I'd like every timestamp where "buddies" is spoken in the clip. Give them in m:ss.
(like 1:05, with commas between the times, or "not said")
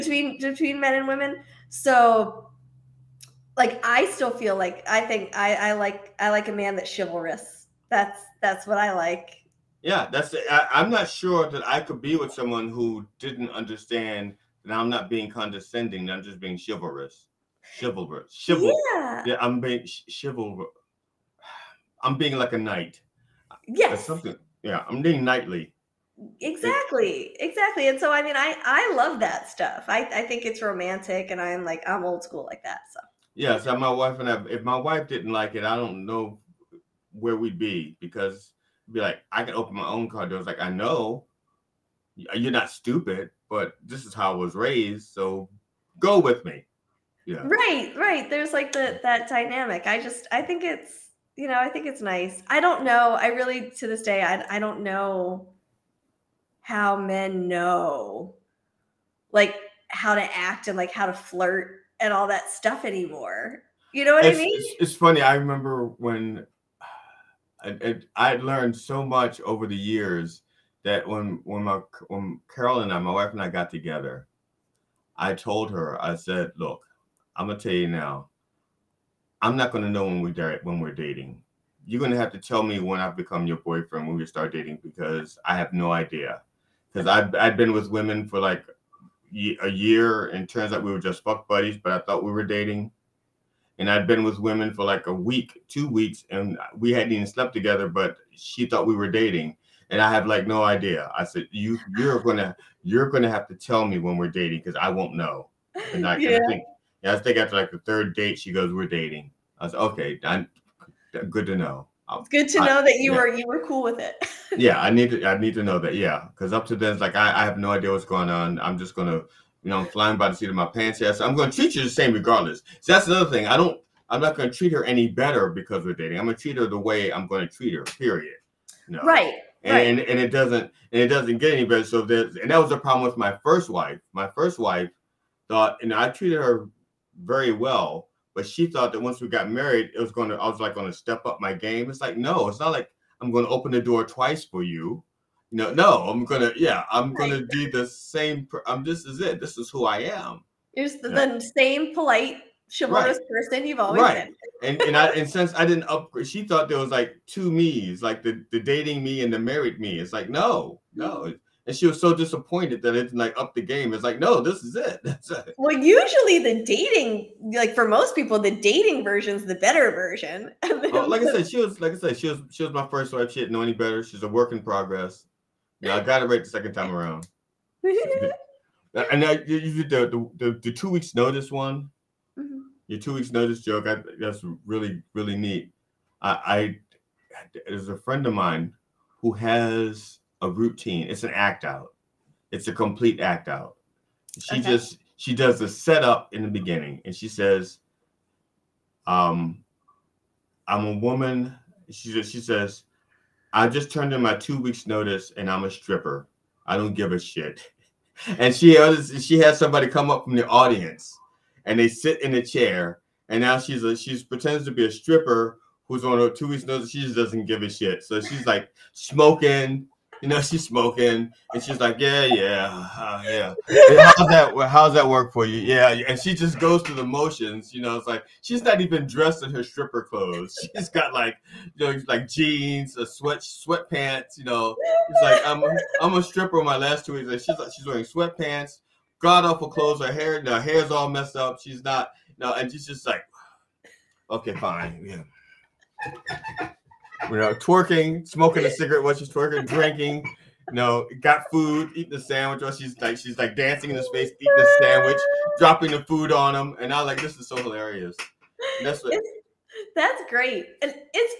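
1:31.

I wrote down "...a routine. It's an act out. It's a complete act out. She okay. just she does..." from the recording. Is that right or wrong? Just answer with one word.
right.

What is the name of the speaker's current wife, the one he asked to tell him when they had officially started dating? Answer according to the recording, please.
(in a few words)
Carol.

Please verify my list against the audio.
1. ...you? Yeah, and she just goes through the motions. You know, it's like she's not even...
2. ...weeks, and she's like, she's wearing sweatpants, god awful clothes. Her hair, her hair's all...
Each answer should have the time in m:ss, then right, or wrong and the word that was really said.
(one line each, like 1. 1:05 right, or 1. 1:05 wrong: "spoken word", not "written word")
1. 3:45 right
2. 3:57 right.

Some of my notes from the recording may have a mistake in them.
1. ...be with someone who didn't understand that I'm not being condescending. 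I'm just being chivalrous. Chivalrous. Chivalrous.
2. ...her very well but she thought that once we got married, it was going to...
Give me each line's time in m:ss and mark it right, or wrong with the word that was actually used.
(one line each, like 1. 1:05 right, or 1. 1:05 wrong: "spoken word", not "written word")
1. 0:12 right
2. 2:16 right.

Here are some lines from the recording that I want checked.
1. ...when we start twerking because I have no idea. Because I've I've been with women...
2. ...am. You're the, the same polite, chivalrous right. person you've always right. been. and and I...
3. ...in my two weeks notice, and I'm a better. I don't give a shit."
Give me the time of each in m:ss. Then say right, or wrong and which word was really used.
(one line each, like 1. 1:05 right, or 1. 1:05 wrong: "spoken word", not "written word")
1. 1:24 wrong: "dating", not "twerking"
2. 2:29 right
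3. 3:24 wrong: "stripper", not "better".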